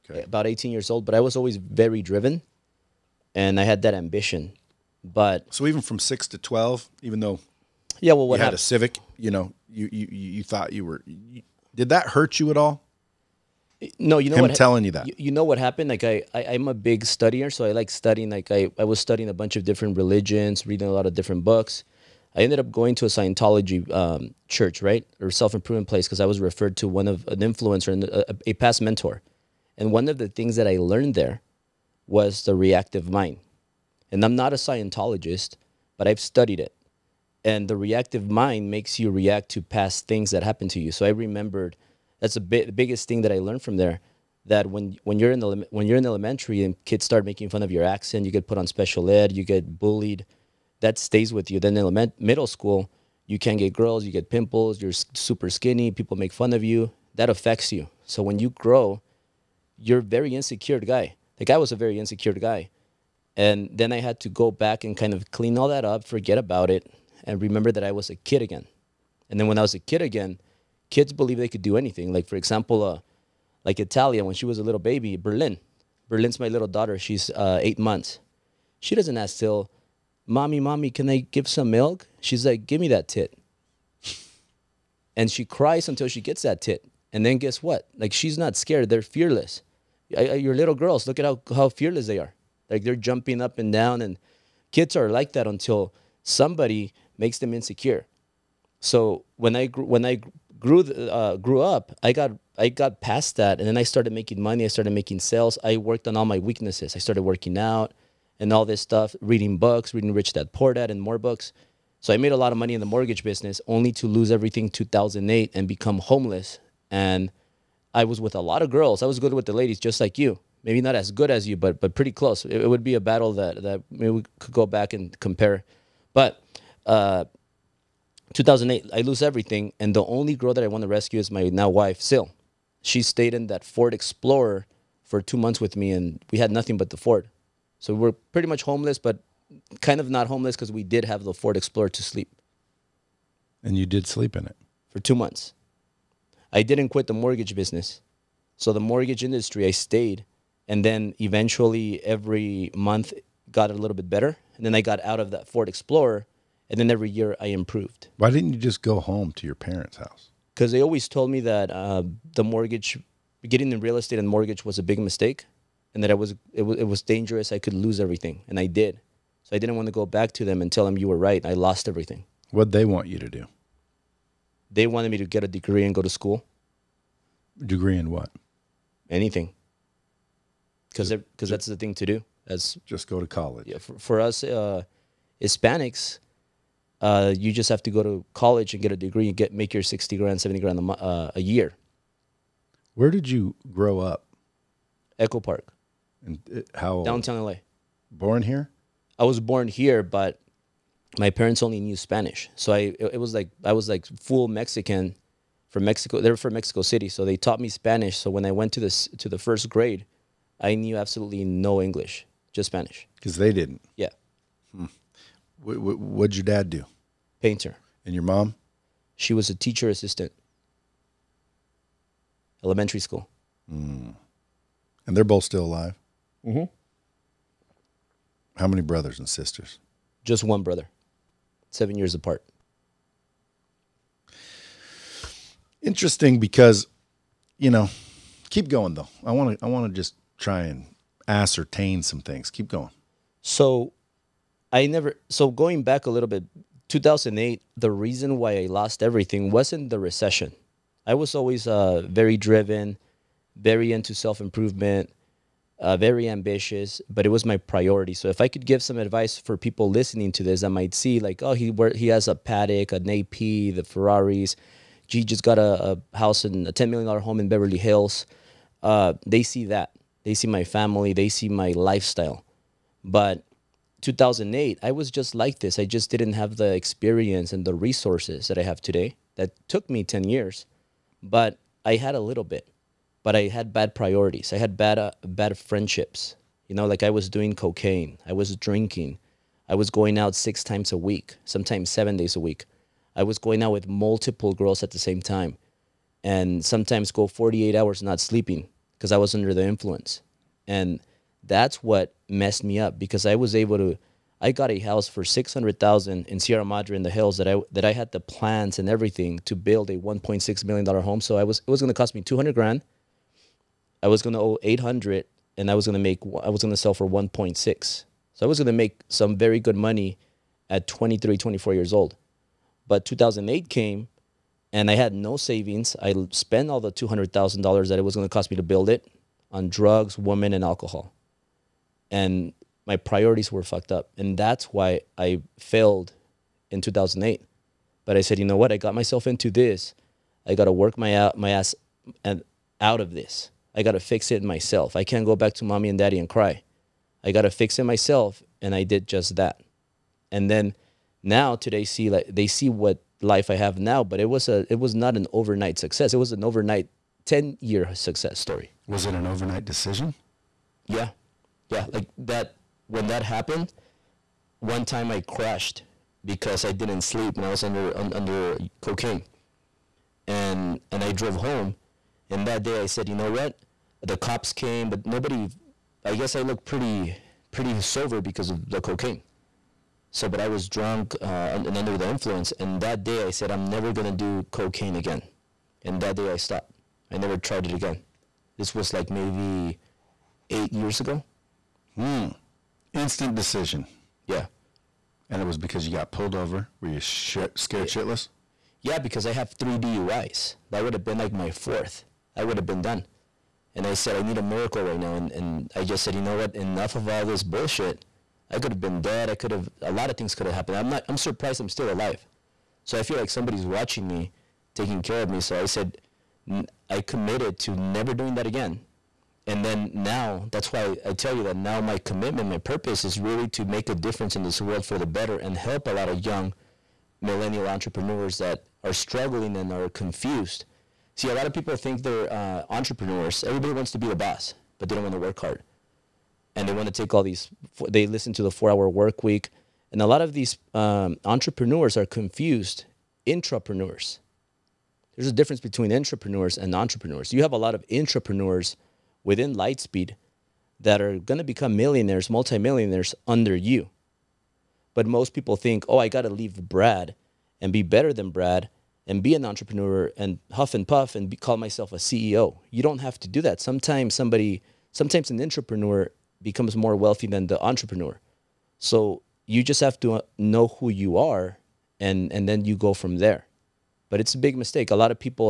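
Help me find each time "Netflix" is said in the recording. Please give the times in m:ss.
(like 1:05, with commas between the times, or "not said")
not said.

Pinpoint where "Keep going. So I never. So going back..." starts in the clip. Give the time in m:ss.
4:02.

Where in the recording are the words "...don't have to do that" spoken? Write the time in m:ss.
7:42.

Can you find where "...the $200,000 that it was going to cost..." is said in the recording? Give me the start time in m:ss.
5:26.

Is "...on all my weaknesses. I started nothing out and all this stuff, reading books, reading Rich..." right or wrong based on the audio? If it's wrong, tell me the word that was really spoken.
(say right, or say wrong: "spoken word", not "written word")
wrong: "working", not "nothing".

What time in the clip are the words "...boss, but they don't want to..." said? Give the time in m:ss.
7:14.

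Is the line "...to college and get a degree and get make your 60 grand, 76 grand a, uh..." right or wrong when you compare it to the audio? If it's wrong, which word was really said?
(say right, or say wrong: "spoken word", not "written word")
wrong: "70", not "76".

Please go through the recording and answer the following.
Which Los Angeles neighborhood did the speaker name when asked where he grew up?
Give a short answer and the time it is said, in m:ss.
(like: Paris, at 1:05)
Echo Park, at 3:15.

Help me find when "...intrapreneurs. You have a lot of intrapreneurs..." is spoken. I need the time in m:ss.
7:26.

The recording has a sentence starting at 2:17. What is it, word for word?
So we we're pretty much homeless, but kind of not homeless because we did have the Ford Explorer to sleep.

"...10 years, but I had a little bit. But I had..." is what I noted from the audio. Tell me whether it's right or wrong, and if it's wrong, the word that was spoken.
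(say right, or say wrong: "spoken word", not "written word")
right.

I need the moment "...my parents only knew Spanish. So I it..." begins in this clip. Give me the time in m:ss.
3:21.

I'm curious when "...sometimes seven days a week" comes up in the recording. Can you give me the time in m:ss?
4:51.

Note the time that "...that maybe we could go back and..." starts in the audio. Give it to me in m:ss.
2:03.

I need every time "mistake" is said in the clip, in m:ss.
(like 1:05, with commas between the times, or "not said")
2:44, 7:54.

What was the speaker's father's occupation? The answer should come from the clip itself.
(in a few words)
Painter.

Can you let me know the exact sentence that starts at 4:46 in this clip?
You know, like I was doing cocaine.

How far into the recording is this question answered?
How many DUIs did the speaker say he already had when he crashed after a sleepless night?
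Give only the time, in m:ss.
6:39.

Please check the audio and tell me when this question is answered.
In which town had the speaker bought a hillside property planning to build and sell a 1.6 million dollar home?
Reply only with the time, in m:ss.
5:06.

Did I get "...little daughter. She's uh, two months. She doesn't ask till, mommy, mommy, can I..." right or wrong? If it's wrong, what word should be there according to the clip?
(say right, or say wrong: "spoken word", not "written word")
wrong: "eight", not "two".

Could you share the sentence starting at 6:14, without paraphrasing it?
The cops came, but nobody I guess I looked pretty pretty sober because of the cocaine.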